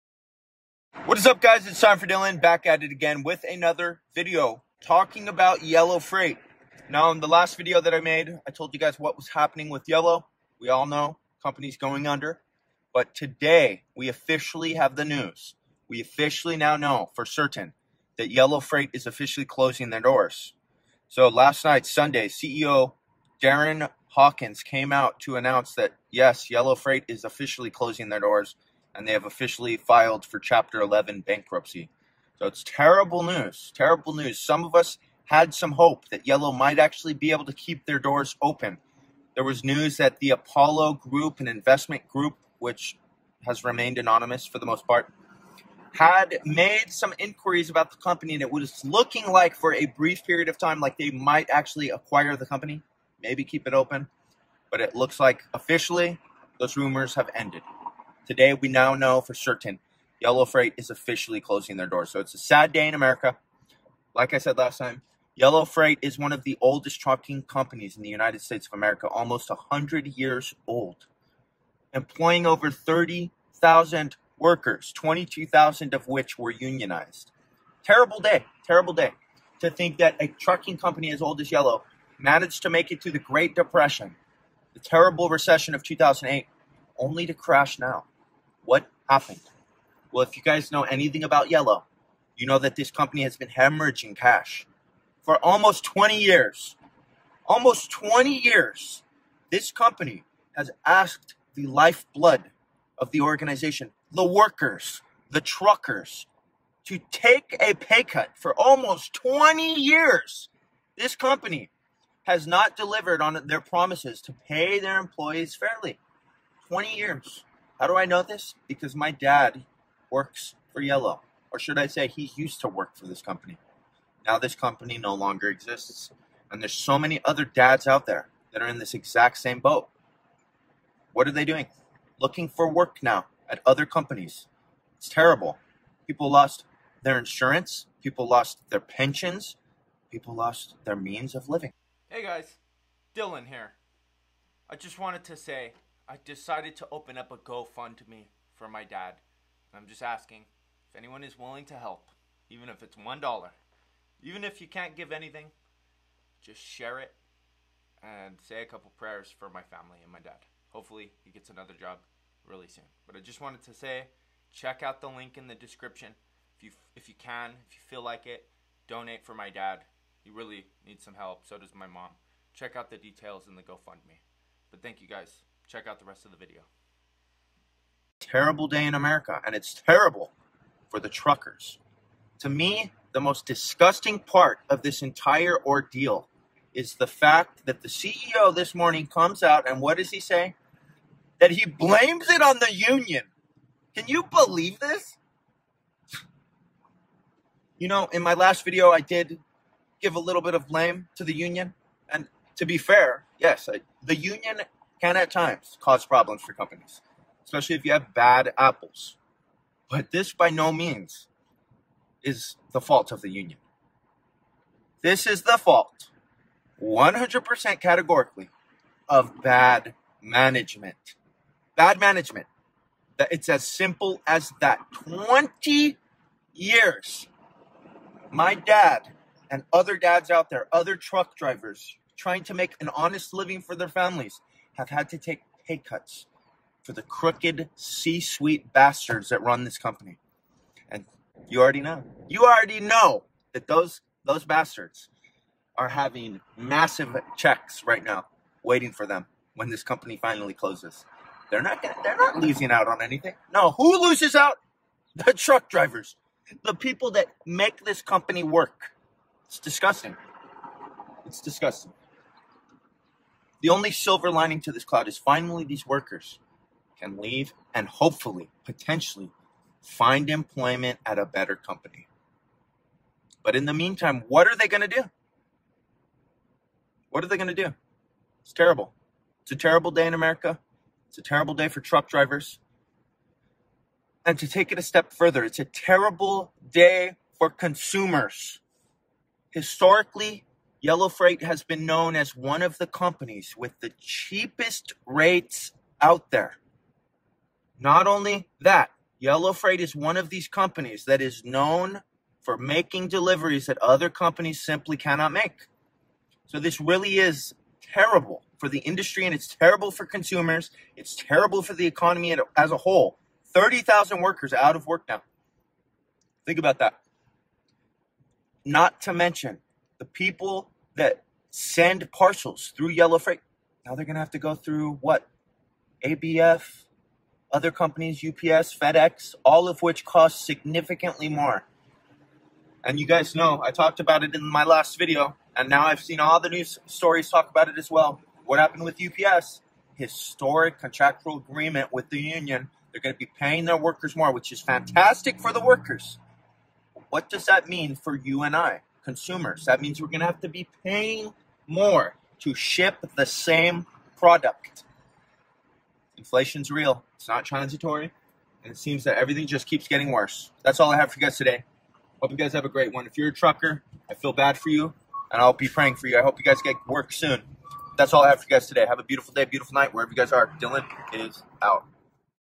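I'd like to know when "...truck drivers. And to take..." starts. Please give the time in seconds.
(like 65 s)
281 s.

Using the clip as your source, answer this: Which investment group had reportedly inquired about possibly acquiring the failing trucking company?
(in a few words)
Apollo Group.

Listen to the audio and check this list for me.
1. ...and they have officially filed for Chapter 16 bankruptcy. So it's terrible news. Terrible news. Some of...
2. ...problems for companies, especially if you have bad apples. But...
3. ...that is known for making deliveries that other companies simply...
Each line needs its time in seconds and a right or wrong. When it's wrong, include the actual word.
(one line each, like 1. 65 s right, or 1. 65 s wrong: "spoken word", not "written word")
1. 28 s wrong: "11", not "16"
2. 206 s right
3. 301 s right.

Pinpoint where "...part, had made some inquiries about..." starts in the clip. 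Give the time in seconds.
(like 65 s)
44 s.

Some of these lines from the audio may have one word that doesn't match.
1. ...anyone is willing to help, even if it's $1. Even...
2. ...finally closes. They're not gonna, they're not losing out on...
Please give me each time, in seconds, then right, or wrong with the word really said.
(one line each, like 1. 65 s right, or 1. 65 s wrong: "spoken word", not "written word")
1. 150 s right
2. 250 s right.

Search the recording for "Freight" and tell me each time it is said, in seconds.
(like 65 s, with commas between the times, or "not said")
5 s, 18 s, 26 s, 60 s, 65 s, 291 s, 299 s, 323 s.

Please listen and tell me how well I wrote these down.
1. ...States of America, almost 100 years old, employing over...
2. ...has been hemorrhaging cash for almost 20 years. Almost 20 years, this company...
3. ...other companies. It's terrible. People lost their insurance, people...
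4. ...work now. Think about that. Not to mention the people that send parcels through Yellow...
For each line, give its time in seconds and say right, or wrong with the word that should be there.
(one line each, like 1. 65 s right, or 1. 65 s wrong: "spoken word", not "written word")
1. 68 s right
2. 93 s right
3. 133 s right
4. 314 s right.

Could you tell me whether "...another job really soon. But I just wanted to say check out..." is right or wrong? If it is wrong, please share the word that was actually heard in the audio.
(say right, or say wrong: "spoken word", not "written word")
right.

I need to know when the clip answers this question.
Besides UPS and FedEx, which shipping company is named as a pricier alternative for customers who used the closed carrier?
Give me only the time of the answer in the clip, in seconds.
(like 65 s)
326 s.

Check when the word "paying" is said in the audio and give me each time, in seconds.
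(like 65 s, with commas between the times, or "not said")
343 s, 350 s.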